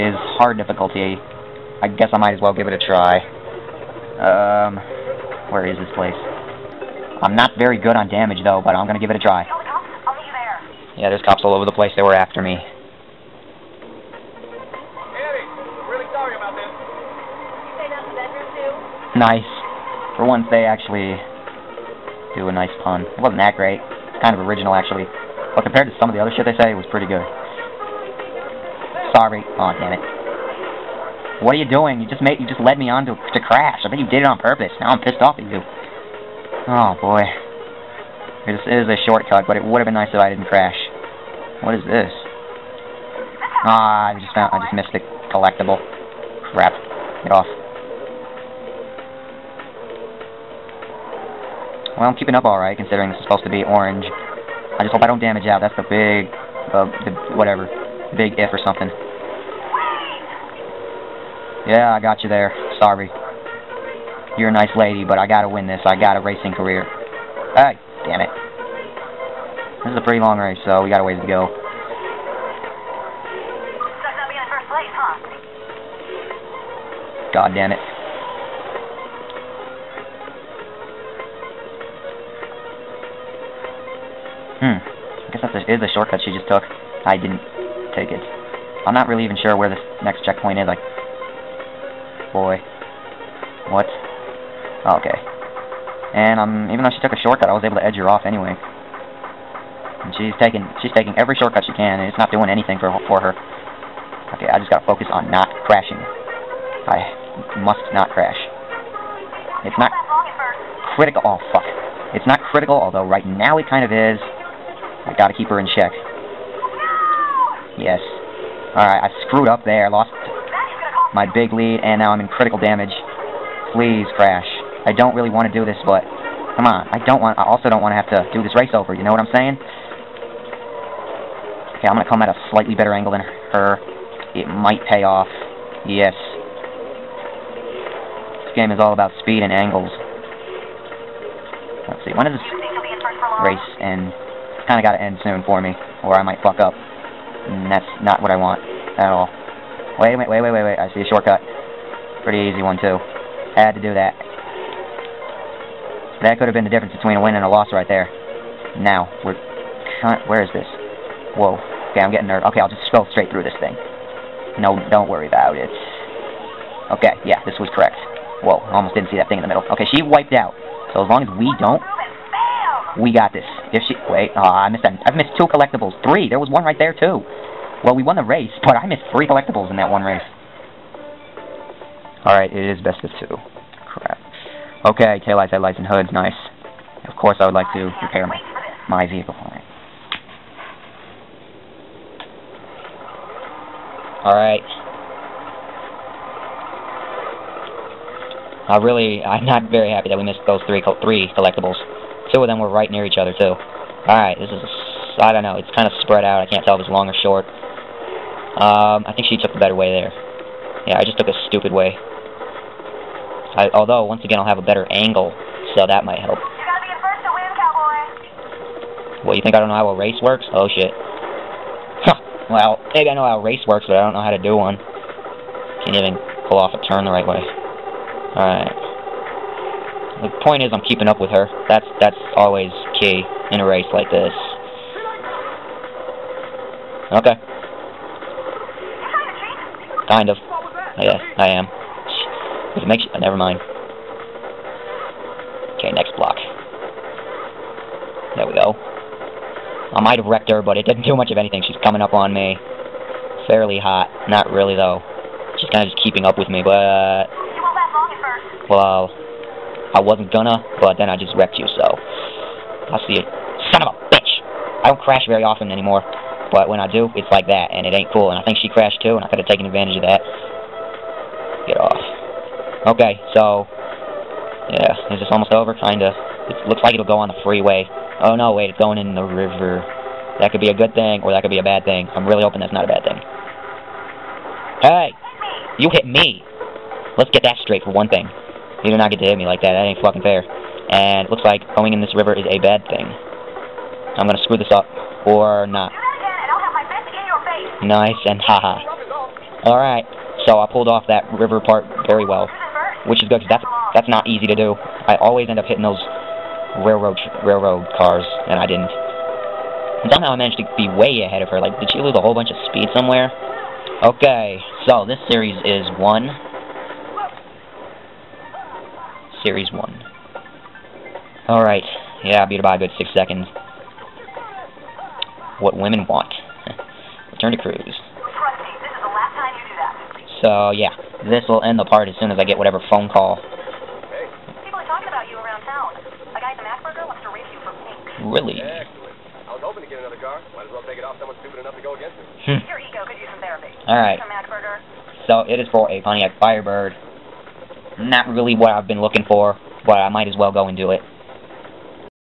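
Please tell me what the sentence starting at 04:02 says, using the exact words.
If it makes you, uh, never mind.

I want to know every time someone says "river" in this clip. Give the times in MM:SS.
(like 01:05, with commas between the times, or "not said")
04:39, 04:52, 05:01.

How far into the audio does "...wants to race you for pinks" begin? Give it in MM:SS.
05:37.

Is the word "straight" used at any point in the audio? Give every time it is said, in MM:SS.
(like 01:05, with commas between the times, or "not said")
02:43, 04:47.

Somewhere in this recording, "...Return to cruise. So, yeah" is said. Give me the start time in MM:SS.
05:27.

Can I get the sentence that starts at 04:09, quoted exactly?
I might have wrecked her, but it didn't do much of anything.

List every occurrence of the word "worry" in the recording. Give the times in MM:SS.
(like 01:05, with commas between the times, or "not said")
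02:45.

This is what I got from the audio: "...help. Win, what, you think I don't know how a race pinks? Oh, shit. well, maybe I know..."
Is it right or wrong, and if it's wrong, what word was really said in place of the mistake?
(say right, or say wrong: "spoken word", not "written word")
wrong: "works", not "pinks".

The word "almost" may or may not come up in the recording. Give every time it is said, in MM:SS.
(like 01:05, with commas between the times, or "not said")
02:48, 04:35.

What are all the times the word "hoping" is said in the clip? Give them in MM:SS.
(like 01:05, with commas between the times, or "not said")
04:42.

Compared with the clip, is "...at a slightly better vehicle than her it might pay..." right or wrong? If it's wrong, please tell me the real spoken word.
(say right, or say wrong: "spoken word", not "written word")
wrong: "angle", not "vehicle".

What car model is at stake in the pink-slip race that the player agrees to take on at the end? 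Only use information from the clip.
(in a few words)
Pontiac Firebird.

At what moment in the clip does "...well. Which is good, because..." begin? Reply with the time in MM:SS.
05:02.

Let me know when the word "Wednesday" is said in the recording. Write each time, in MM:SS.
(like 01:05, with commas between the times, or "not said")
not said.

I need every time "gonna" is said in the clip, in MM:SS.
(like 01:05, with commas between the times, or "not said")
04:20, 04:54.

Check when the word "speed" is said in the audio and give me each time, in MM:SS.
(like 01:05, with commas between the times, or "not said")
02:19, 05:12.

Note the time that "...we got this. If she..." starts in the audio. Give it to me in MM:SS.
02:52.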